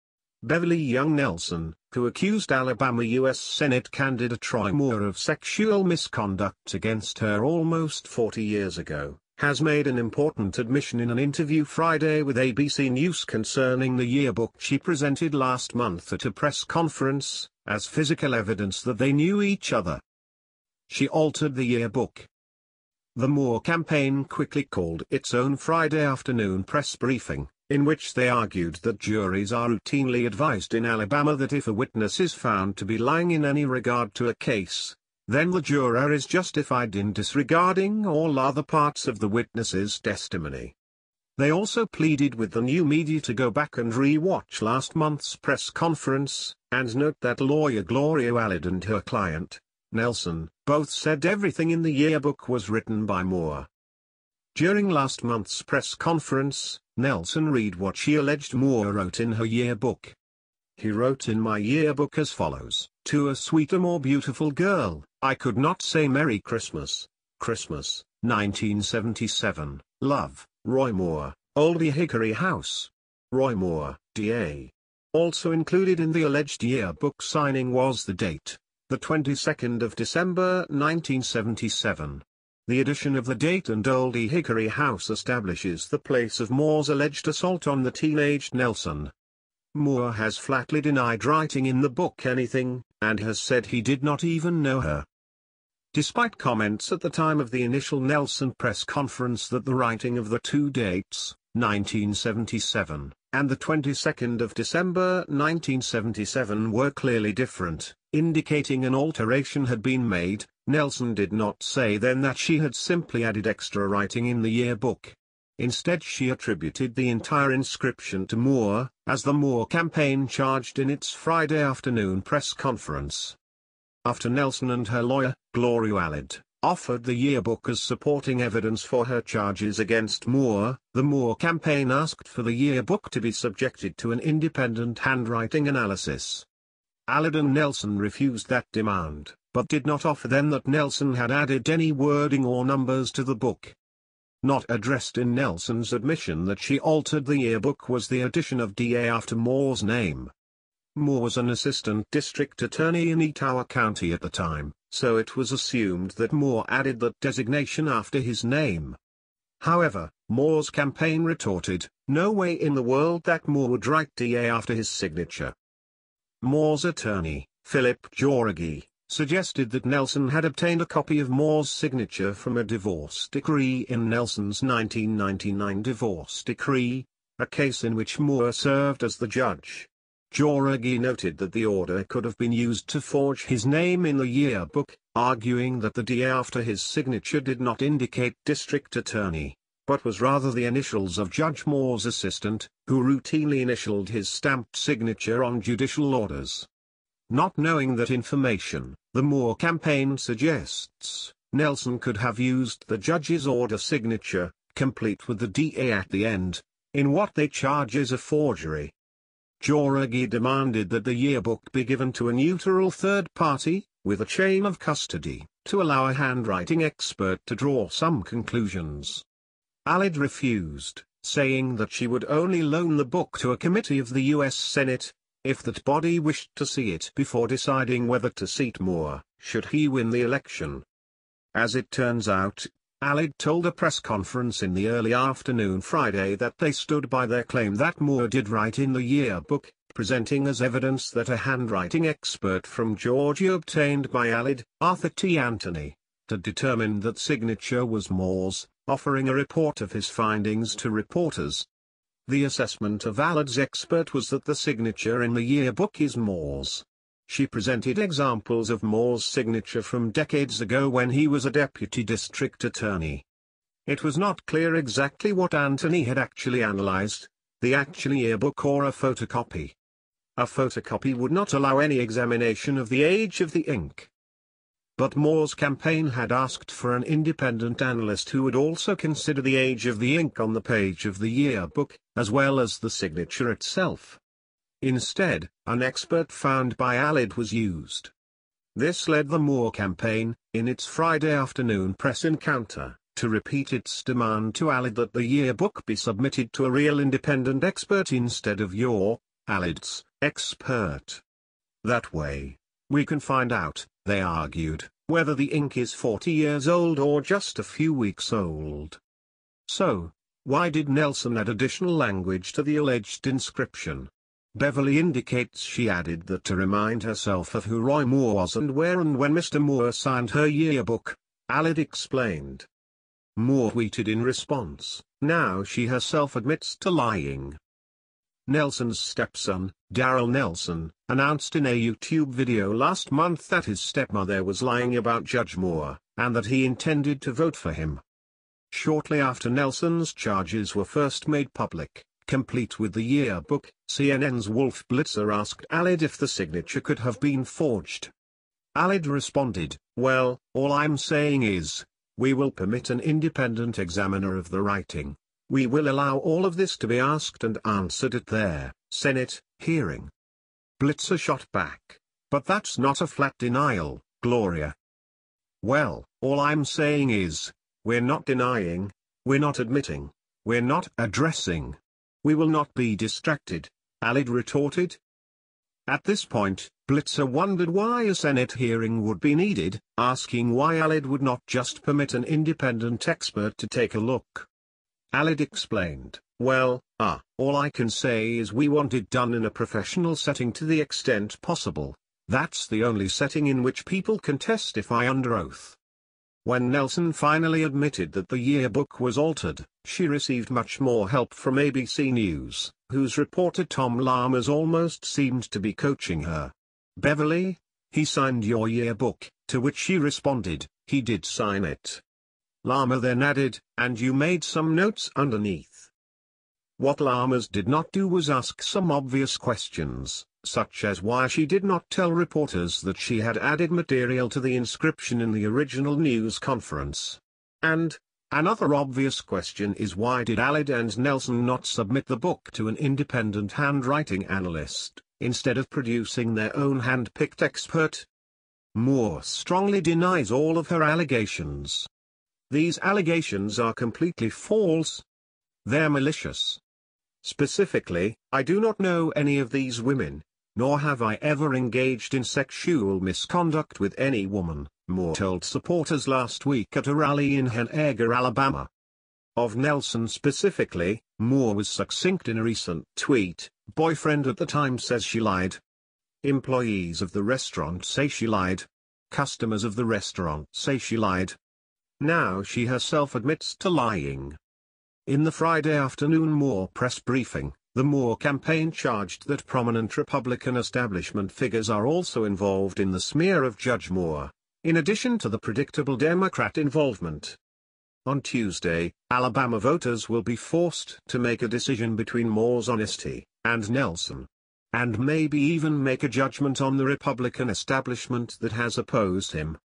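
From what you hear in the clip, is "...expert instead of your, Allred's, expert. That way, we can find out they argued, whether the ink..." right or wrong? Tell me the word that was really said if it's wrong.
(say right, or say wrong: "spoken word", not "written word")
right.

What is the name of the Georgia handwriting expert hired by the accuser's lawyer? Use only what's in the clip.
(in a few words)
Arthur T. Anthony.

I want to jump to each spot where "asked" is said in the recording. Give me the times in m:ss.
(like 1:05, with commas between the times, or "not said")
2:11, 4:36, 5:45, 5:56.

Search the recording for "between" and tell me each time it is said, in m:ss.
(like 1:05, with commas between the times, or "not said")
8:11.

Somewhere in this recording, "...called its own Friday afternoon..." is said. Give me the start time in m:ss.
0:24.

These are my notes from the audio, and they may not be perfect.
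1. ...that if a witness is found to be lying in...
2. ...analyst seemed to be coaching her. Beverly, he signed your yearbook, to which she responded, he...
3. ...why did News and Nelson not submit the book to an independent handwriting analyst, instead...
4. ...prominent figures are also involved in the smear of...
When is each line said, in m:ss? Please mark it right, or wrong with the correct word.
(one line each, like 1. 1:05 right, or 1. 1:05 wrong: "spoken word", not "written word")
1. 0:31 right
2. 6:44 wrong: "almost", not "analyst"
3. 7:09 wrong: "Allred", not "News"
4. 8:00 wrong: "establishment", not "prominent".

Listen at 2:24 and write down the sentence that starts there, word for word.
Not addressed in Nelson's admission that she altered the yearbook was the addition of DA after Moore's name.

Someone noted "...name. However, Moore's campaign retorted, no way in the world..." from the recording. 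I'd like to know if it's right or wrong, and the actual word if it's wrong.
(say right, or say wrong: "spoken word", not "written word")
right.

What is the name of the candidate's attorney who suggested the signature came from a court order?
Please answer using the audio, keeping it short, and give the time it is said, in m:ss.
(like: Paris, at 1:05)
Philip Jauregui, at 2:47.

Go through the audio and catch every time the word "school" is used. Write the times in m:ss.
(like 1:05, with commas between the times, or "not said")
not said.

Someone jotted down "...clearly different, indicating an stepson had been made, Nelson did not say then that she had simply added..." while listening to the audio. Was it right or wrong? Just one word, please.
wrong.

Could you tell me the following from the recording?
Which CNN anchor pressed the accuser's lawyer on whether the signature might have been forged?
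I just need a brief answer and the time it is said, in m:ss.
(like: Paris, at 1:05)
Wolf Blitzer, at 5:44.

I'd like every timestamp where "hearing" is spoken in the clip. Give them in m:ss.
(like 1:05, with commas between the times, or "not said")
5:59, 6:18.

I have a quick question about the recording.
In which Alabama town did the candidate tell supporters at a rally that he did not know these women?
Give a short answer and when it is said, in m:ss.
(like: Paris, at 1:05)
Henagar, at 7:37.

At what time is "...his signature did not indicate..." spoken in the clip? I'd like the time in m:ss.
3:06.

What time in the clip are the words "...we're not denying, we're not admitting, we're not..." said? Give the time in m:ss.
6:07.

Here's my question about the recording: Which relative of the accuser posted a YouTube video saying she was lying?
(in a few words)
Daryl Nelson.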